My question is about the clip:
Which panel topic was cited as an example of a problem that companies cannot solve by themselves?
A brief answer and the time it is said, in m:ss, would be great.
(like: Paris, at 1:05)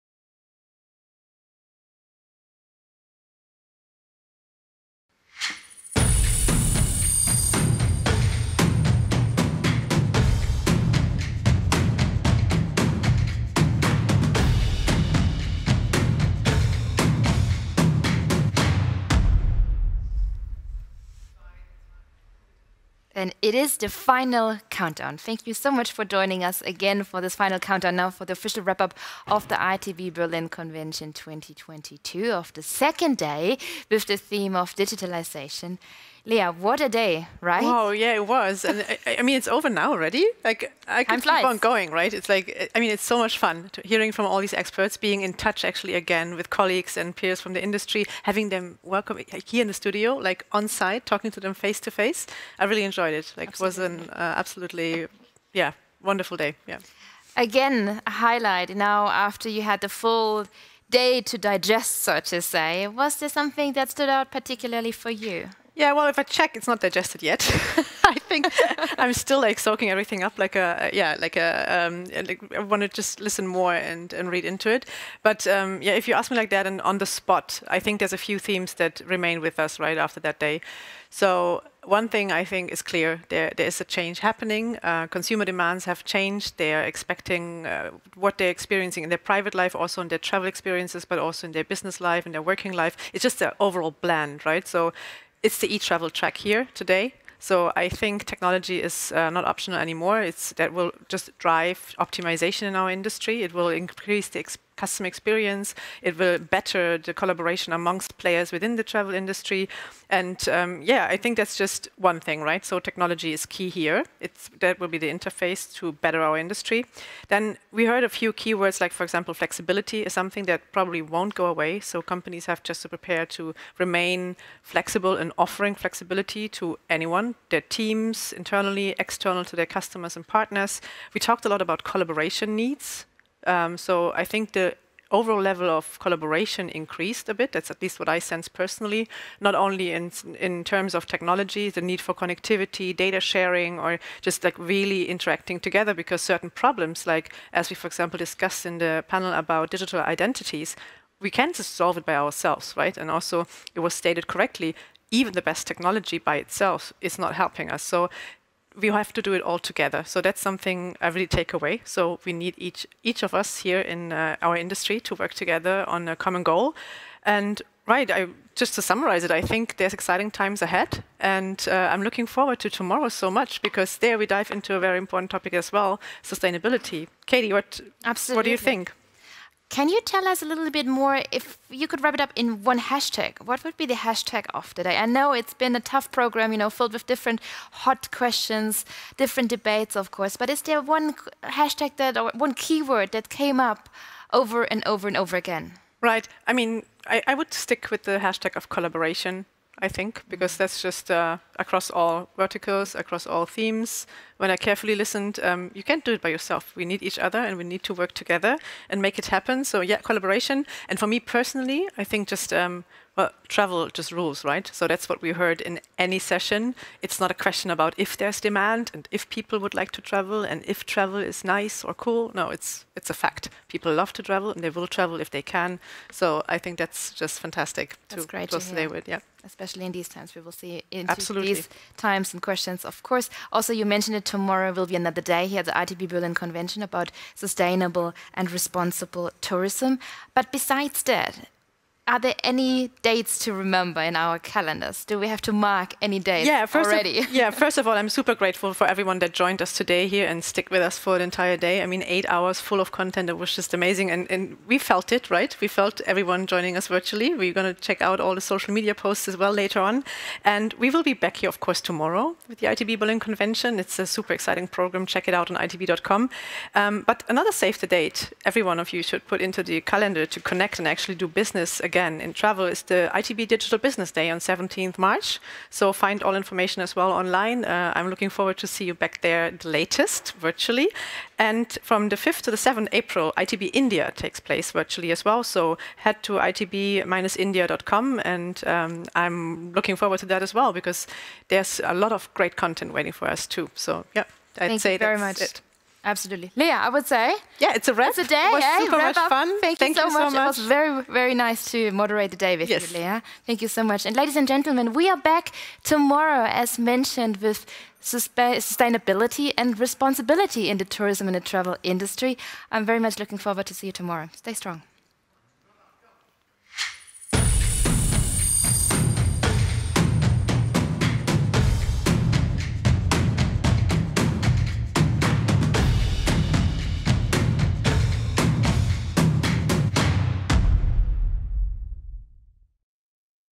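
Digital identities, at 2:29.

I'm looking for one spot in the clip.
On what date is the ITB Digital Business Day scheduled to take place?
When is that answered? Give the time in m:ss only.
4:34.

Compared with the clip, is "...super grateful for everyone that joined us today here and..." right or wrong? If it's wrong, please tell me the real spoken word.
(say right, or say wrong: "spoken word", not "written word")
right.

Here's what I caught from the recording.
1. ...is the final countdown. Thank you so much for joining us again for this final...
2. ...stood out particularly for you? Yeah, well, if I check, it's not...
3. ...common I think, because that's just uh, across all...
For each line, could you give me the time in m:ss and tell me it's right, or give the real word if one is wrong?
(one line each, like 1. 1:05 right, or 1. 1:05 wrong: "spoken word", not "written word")
1. 0:23 right
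2. 1:03 right
3. 3:18 wrong: "collaboration", not "common".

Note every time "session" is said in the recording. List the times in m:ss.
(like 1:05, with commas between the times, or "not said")
3:36.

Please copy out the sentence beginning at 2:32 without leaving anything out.
And also, it was stated correctly, even the best technology by itself is not helping us.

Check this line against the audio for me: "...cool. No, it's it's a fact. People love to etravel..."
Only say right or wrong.
wrong.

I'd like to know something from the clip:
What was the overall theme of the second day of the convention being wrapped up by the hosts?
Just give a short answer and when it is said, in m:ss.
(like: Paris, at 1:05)
Digitalization, at 0:34.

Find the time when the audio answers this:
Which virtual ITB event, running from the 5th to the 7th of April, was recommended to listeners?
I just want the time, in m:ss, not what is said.
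4:43.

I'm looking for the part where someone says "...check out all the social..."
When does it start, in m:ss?
4:17.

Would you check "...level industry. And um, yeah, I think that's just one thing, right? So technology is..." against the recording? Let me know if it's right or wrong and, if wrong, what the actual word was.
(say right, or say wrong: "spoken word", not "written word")
wrong: "travel", not "level".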